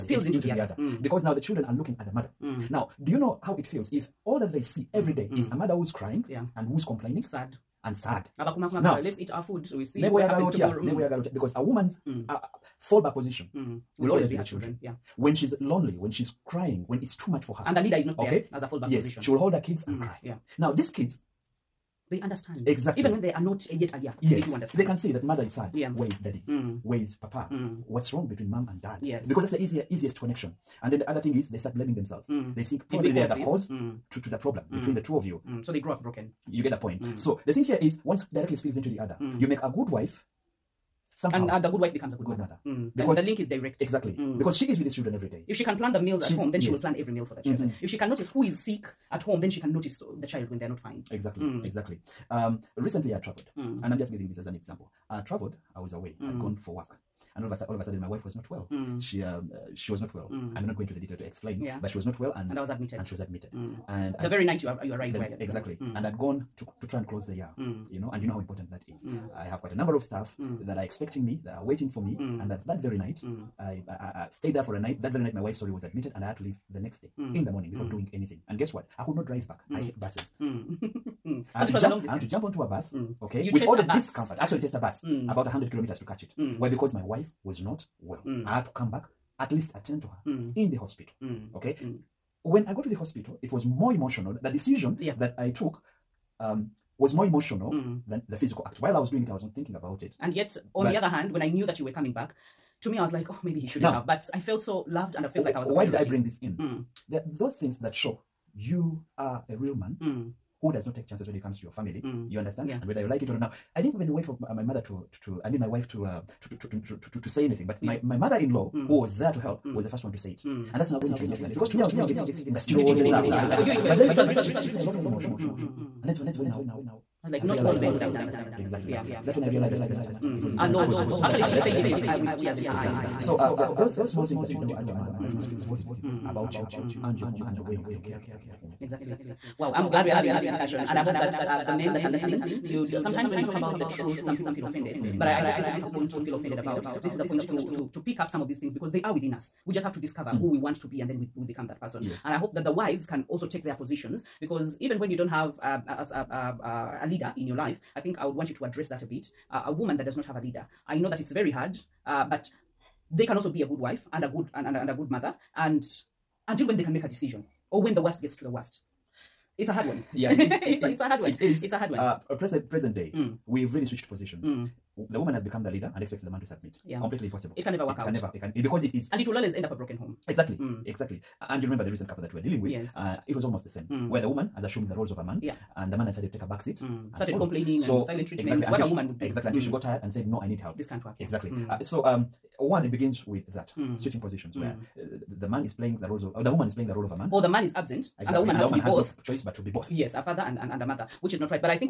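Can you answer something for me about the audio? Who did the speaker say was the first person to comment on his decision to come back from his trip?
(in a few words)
mother-in-law.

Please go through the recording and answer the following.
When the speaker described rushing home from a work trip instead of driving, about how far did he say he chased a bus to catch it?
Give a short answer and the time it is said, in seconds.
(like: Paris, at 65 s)
100 kilometers, at 85 s.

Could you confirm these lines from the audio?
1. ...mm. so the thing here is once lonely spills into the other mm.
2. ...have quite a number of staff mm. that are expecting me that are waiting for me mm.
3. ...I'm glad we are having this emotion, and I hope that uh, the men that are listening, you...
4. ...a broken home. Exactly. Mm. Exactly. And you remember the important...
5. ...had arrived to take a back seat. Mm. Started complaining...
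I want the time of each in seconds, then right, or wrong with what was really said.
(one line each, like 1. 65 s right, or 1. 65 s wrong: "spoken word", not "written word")
1. 37 s wrong: "directly", not "lonely"
2. 69 s right
3. 139 s wrong: "discussion", not "emotion"
4. 179 s wrong: "recent", not "important"
5. 186 s wrong: "started", not "arrived".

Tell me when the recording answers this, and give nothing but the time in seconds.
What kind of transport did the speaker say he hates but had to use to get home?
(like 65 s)
80 s.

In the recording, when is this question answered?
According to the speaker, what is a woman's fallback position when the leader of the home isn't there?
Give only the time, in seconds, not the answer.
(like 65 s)
14 s.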